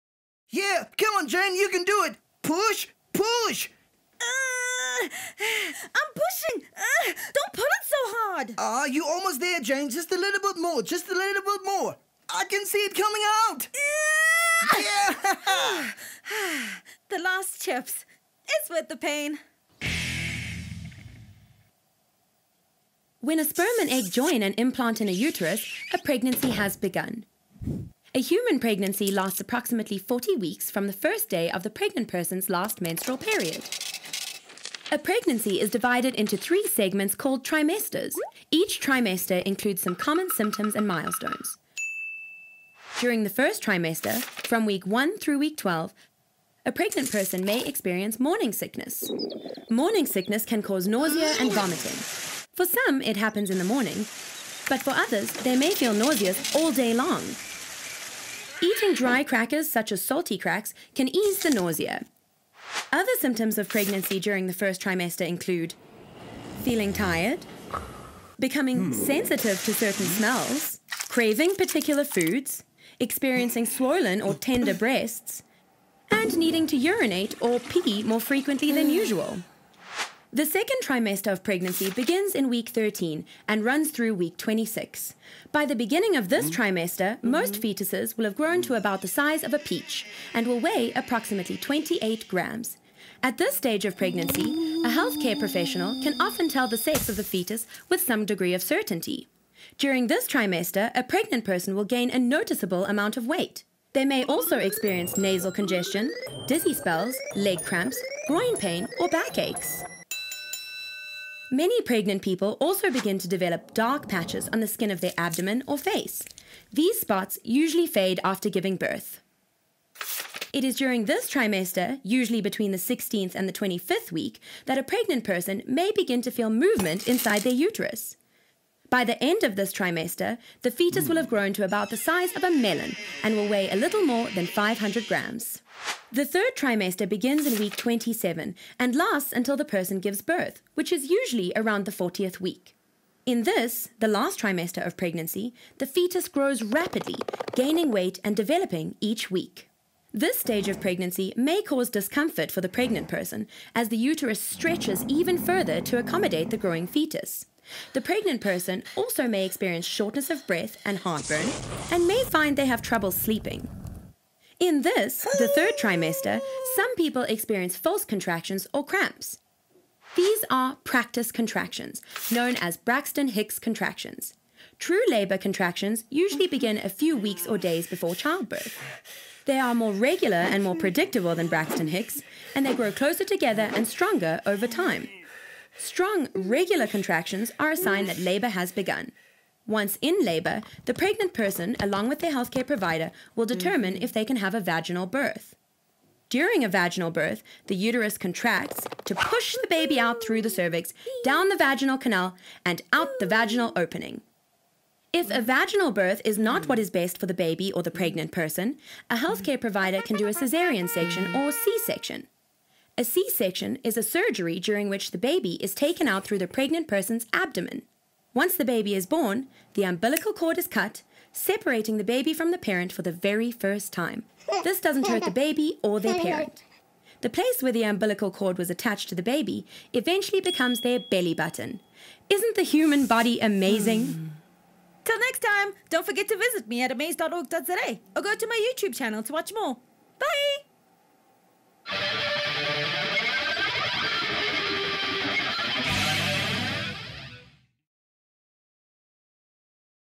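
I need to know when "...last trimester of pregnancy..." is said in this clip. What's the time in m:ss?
2:24.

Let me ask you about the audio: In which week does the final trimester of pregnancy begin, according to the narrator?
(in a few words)
Week 27.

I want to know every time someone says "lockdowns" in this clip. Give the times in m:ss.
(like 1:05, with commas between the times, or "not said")
not said.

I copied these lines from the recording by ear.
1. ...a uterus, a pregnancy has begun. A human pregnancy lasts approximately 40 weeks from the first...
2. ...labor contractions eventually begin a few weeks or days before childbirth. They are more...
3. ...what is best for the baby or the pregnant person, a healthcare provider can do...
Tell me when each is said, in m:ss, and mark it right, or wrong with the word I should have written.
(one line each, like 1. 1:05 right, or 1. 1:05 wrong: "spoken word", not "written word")
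1. 0:25 right
2. 2:55 wrong: "usually", not "eventually"
3. 3:26 right.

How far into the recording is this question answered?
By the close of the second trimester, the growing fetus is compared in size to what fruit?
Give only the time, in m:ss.
2:12.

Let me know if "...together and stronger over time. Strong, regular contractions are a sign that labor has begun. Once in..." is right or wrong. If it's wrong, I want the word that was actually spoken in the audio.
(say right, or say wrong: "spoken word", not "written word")
right.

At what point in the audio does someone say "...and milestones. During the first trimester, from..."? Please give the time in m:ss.
0:40.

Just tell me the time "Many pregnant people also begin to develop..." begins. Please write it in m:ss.
1:51.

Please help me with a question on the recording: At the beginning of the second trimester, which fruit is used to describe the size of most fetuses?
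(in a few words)
Peach.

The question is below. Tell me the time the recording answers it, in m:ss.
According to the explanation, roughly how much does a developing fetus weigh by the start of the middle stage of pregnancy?
1:31.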